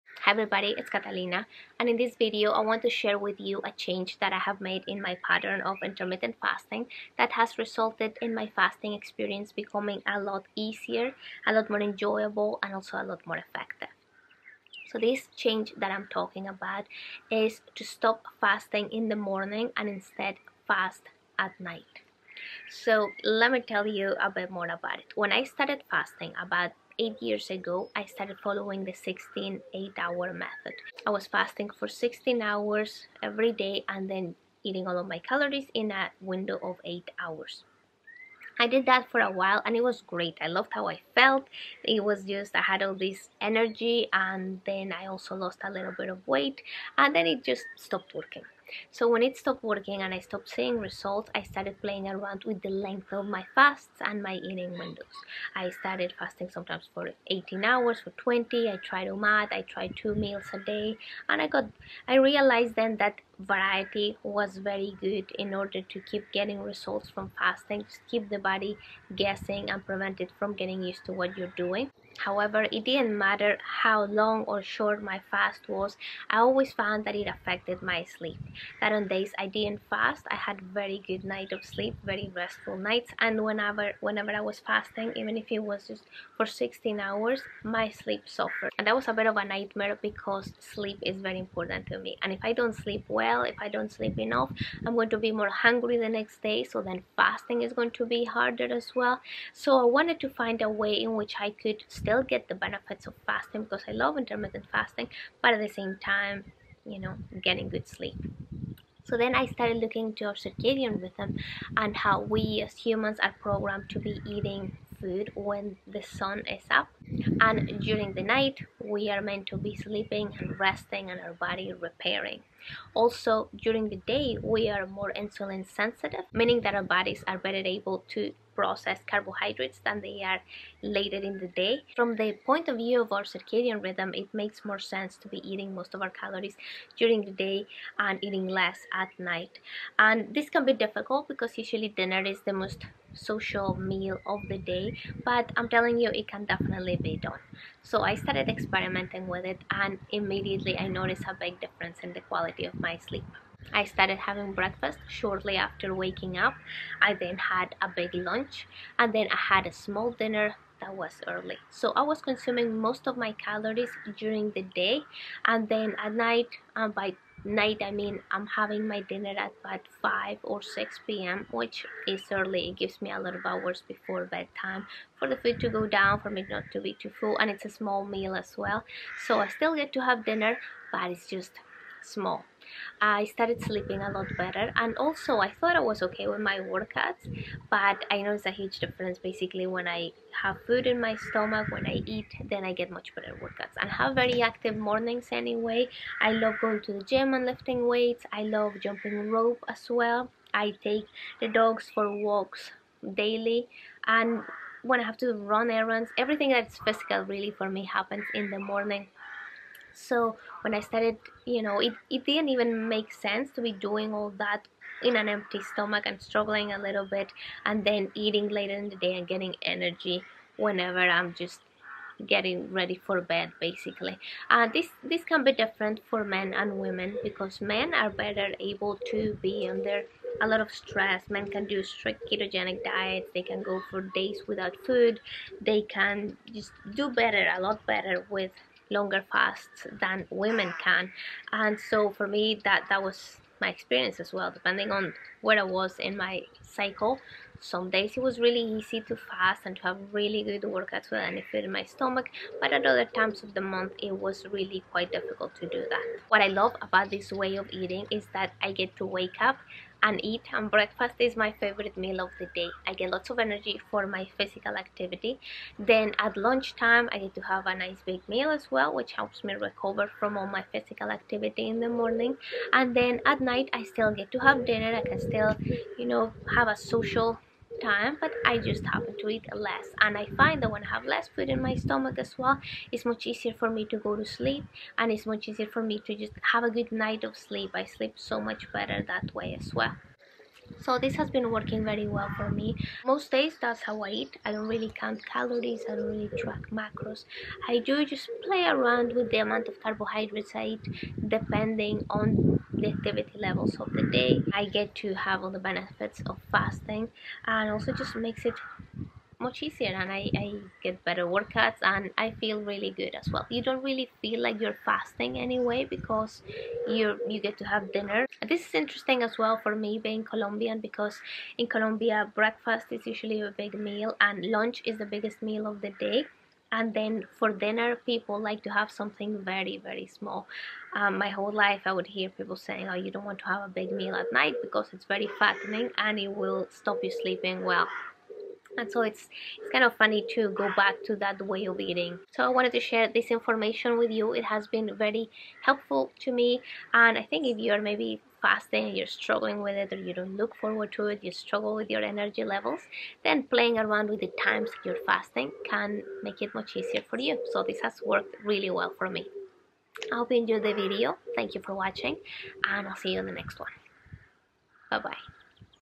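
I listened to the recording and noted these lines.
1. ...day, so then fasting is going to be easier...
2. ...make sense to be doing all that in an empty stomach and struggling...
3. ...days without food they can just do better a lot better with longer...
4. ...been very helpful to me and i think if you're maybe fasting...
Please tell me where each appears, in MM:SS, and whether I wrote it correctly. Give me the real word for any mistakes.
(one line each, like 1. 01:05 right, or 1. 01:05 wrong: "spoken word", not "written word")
1. 01:36 wrong: "harder", not "easier"
2. 03:32 right
3. 03:54 right
4. 05:44 right.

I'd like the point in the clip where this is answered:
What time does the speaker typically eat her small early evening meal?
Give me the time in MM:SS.
02:50.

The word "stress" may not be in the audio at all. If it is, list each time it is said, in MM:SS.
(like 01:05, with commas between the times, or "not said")
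03:50.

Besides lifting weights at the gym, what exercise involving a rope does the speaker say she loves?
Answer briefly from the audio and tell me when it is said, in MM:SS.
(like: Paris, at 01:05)
Jumping rope, at 03:18.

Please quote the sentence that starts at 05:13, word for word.
You don't really feel like you're fasting anyway because you you get to have dinner.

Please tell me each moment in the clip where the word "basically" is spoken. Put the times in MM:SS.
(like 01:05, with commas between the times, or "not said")
03:09, 03:43.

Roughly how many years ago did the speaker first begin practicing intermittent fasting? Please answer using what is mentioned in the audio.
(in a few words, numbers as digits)
8.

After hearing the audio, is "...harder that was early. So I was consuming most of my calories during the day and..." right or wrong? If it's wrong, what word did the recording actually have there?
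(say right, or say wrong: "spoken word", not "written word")
wrong: "dinner", not "harder".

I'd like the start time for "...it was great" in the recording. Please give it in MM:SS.
00:39.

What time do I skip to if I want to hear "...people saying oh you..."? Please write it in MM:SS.
05:32.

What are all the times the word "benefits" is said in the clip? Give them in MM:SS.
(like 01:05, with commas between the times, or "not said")
01:42, 05:05.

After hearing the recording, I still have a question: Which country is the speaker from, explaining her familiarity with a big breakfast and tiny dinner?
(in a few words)
Colombia.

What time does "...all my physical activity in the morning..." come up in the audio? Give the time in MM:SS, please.
04:30.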